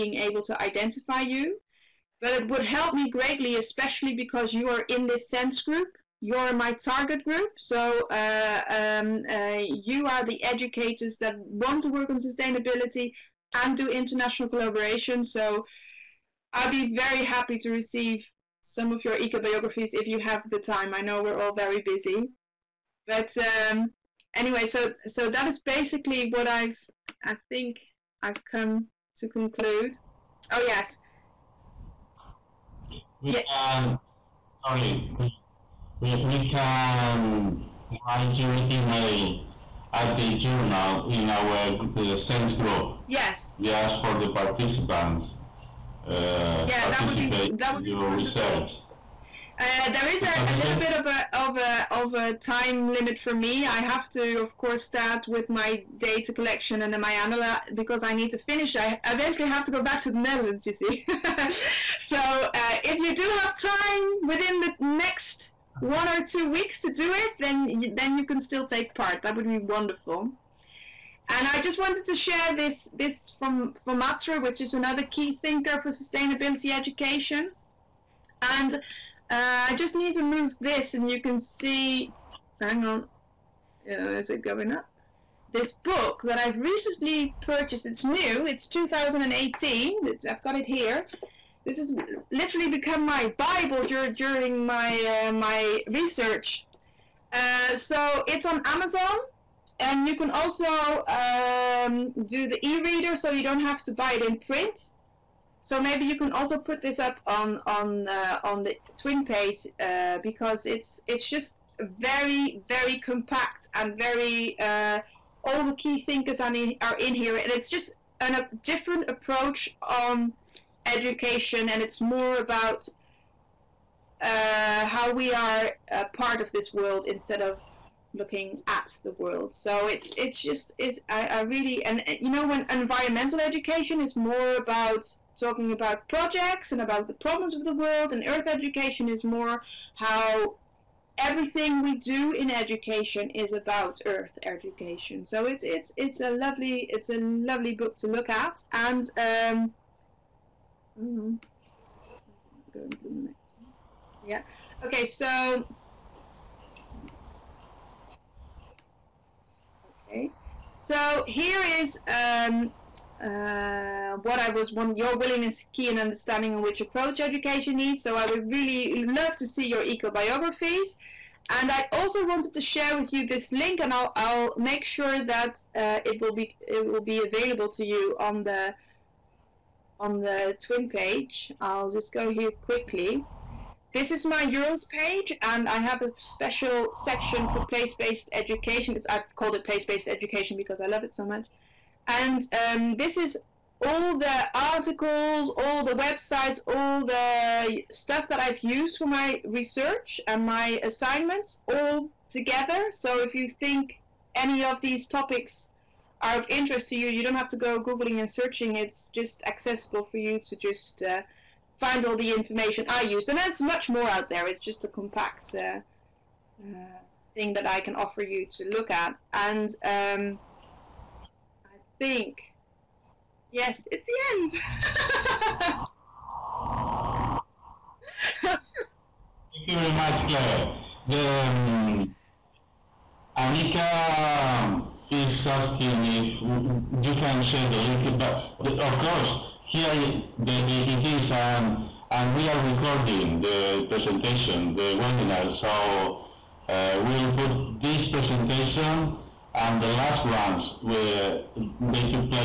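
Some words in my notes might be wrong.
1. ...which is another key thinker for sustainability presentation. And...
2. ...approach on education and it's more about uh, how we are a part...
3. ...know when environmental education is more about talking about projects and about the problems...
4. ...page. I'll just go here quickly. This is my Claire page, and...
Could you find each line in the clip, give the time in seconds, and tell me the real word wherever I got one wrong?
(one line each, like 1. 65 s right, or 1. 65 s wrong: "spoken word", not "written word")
1. 74 s wrong: "education", not "presentation"
2. 119 s right
3. 132 s right
4. 180 s wrong: "URLs", not "Claire".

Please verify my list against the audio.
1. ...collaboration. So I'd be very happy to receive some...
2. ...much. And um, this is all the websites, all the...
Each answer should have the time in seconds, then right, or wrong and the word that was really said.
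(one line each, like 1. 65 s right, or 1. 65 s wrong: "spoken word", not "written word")
1. 14 s right
2. 191 s wrong: "articles", not "websites".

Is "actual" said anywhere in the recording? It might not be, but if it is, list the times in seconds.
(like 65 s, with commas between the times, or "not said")
not said.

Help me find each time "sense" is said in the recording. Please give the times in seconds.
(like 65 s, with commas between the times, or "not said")
5 s, 42 s.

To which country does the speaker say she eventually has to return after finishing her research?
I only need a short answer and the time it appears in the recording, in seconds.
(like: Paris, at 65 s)
The Netherlands, at 60 s.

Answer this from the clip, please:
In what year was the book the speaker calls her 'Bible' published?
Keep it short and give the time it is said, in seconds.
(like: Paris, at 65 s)
2018, at 88 s.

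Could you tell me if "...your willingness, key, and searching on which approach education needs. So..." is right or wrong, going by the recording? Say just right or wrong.
wrong.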